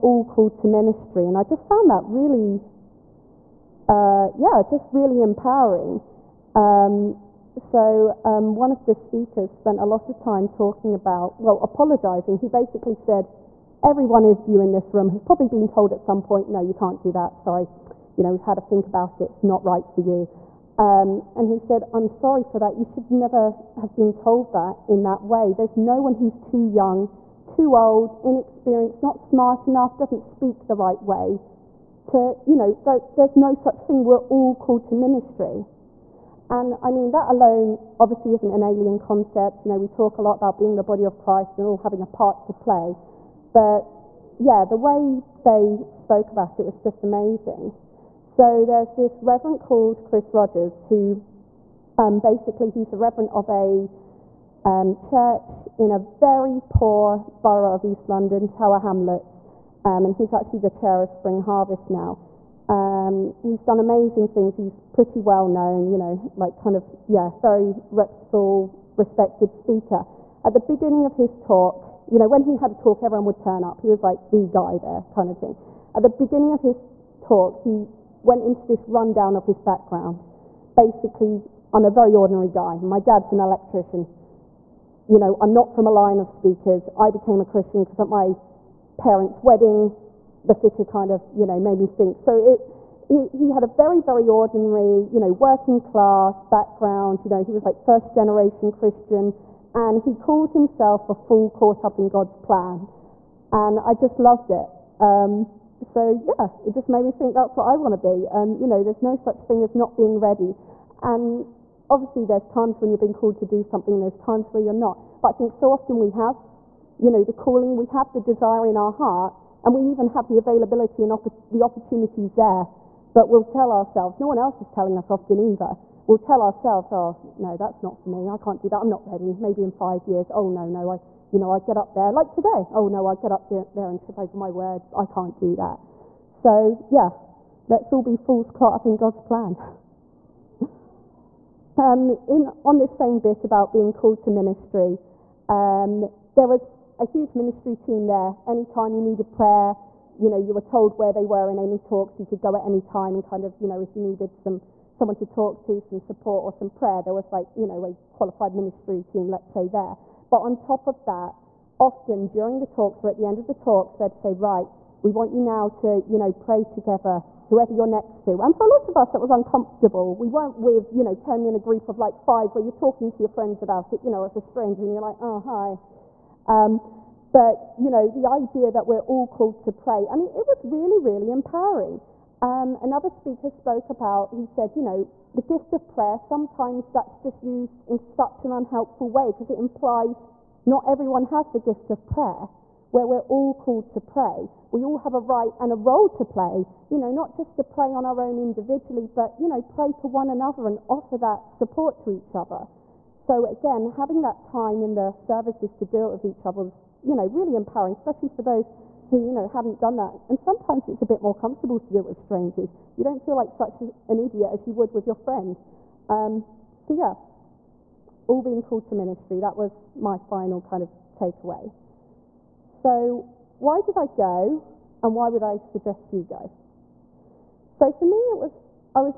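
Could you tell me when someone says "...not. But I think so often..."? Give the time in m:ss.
1:54.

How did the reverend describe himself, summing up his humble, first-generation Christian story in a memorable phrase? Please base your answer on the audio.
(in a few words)
A fool caught up in God's plan.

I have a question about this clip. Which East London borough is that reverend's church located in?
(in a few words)
Tower Hamlets.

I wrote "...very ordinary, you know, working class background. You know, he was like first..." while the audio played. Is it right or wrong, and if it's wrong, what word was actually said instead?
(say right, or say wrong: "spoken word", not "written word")
right.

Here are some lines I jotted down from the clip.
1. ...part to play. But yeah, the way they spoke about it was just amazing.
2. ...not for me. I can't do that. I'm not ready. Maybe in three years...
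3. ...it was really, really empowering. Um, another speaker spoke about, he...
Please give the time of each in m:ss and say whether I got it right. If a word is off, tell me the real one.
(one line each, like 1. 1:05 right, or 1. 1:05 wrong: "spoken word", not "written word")
1. 0:42 right
2. 2:07 wrong: "five", not "three"
3. 3:00 right.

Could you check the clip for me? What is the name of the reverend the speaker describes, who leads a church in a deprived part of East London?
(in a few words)
Chris Rogers.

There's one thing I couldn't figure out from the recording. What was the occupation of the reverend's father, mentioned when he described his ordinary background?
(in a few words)
Electrician.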